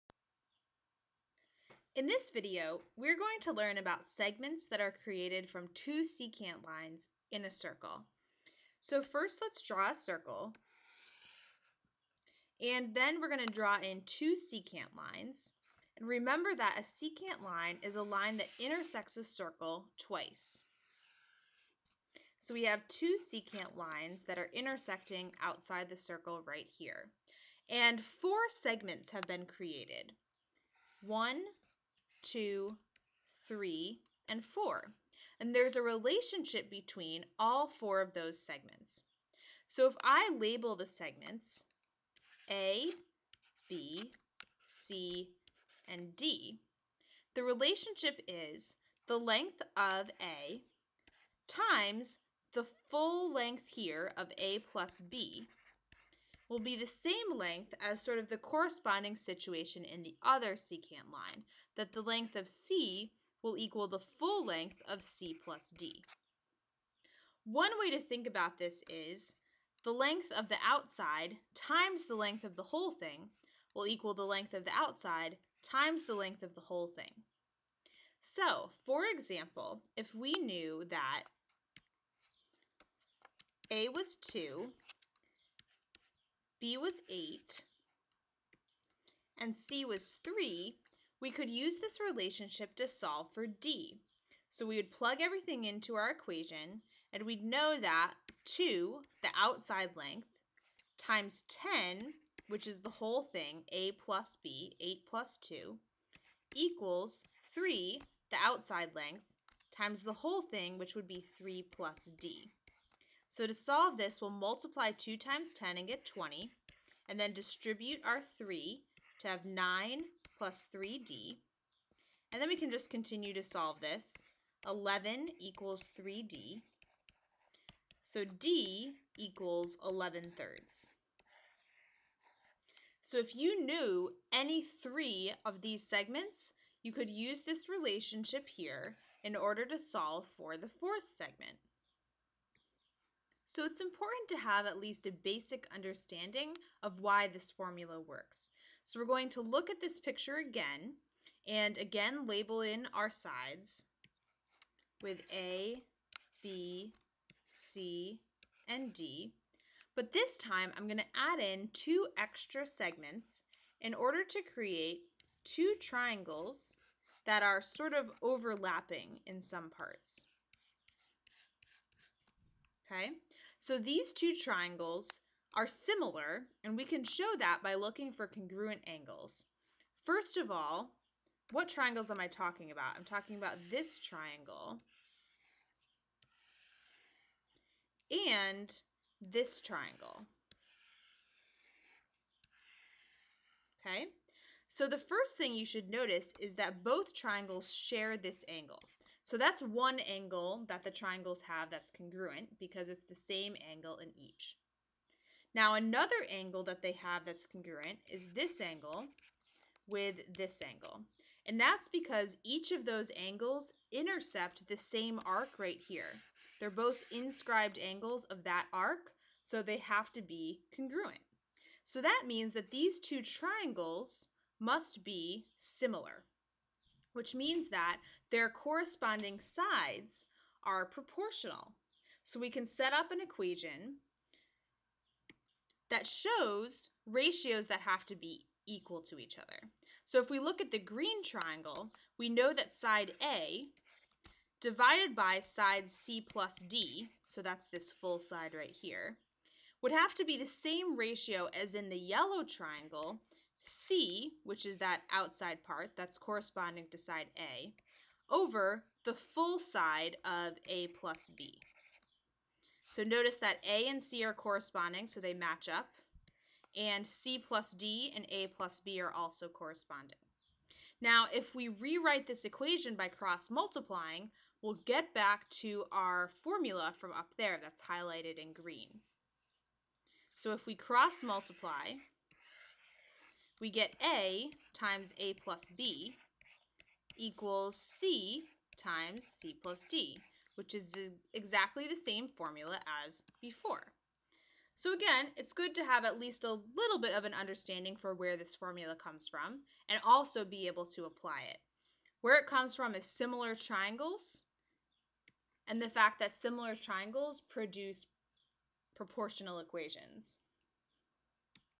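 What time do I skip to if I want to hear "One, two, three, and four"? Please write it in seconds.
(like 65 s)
31 s.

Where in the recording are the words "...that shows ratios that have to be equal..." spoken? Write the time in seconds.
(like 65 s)
235 s.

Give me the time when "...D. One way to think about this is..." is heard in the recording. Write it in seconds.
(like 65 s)
65 s.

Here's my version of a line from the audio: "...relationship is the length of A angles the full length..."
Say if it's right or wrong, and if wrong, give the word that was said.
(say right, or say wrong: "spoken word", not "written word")
wrong: "times", not "angles".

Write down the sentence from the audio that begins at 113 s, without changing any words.
So to solve this, we'll multiply 2 times 10 and get 20, and then distribute our 3 to have 9 plus 3d.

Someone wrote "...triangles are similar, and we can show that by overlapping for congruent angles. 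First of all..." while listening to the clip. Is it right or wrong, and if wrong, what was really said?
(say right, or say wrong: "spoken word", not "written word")
wrong: "looking", not "overlapping".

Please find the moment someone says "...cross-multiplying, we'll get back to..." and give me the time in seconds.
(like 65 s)
273 s.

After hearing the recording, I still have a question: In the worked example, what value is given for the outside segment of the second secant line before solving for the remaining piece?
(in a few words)
3.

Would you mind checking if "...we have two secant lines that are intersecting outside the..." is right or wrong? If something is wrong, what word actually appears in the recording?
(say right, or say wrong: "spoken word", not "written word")
right.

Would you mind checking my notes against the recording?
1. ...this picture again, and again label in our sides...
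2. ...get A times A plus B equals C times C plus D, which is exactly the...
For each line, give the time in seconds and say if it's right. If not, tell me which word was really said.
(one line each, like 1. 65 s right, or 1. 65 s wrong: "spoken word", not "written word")
1. 149 s right
2. 283 s right.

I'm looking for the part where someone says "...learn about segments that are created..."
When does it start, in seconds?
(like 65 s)
3 s.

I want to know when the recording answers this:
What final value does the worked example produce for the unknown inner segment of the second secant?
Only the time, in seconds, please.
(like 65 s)
129 s.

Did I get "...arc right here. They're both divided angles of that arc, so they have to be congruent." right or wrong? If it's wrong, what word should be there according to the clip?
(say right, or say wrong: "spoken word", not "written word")
wrong: "inscribed", not "divided".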